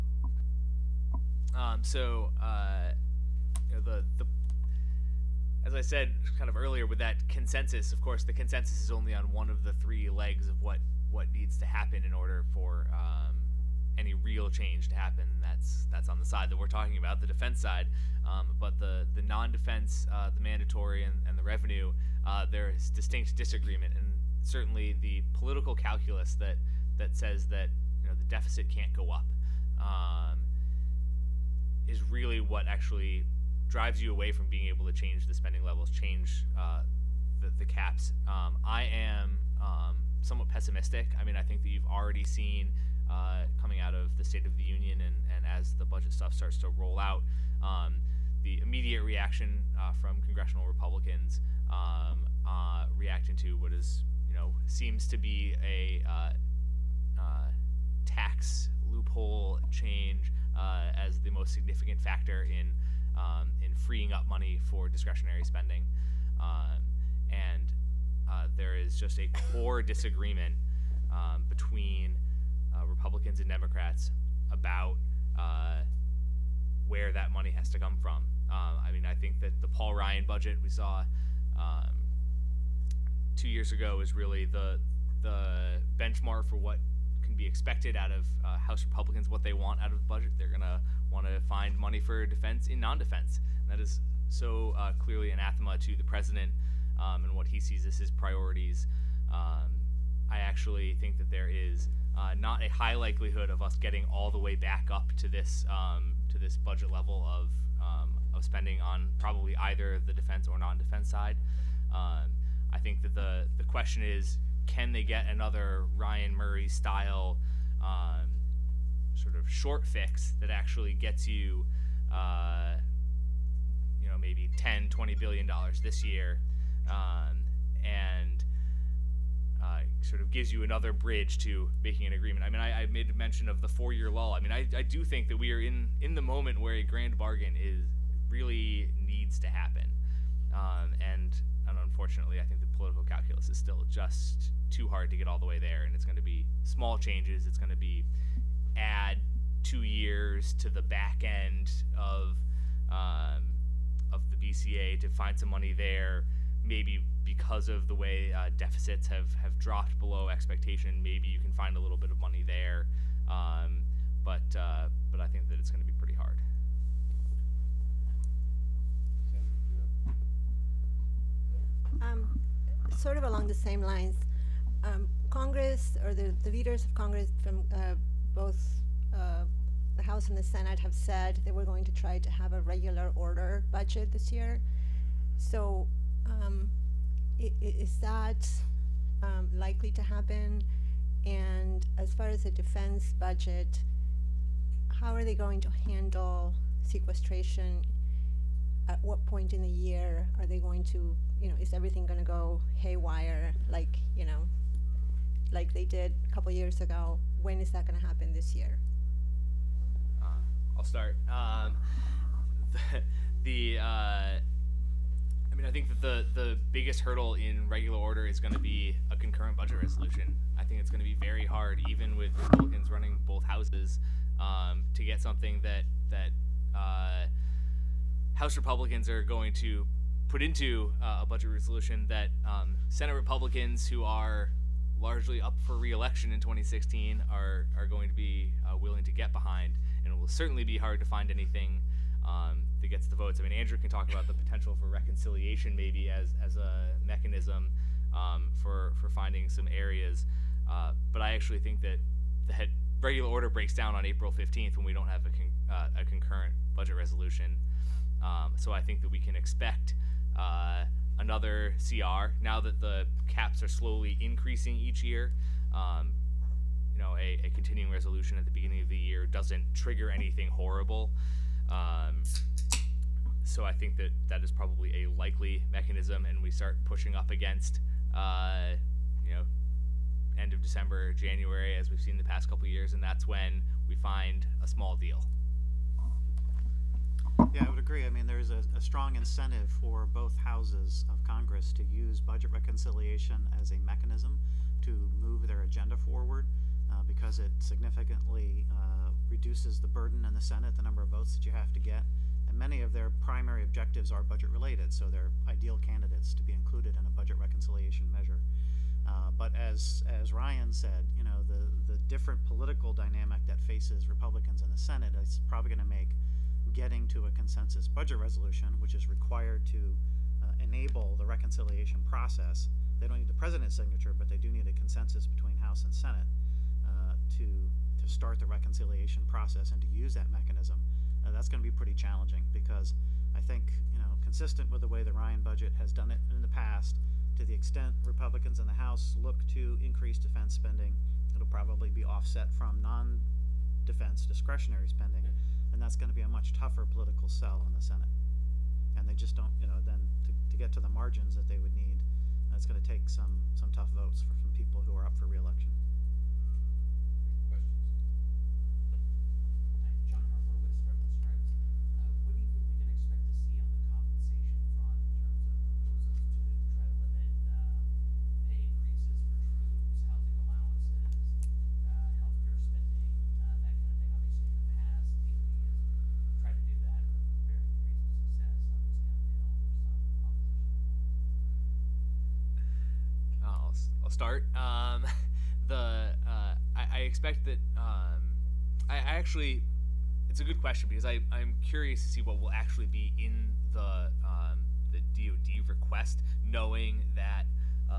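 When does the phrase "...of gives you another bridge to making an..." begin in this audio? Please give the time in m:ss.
2:10.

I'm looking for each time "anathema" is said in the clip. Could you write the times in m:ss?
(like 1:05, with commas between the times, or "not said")
1:35.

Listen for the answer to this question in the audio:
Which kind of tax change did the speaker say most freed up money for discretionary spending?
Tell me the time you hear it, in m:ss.
0:58.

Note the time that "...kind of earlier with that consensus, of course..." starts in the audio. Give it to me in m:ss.
0:06.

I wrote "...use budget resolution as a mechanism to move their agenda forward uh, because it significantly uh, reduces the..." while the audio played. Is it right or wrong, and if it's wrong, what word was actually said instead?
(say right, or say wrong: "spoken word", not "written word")
wrong: "reconciliation", not "resolution".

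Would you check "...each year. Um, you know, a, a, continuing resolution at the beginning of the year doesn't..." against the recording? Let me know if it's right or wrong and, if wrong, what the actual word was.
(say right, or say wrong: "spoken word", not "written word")
right.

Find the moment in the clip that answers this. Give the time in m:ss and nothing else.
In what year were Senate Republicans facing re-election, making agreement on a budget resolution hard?
3:56.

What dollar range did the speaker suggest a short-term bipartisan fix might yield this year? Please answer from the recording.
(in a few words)
10 to 20 billion dollars.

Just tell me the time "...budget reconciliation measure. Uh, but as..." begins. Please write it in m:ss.
5:07.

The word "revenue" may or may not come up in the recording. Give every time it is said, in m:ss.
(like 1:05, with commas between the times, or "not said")
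0:21.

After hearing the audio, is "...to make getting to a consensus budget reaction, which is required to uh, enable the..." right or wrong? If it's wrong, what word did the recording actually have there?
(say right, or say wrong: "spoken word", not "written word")
wrong: "resolution", not "reaction".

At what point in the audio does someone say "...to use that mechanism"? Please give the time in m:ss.
5:29.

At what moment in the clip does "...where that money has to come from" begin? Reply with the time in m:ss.
1:16.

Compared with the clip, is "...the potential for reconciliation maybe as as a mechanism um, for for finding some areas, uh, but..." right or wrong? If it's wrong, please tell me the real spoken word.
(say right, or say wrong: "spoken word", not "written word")
right.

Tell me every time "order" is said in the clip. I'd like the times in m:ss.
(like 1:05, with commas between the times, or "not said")
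0:12, 3:03, 3:37, 4:13.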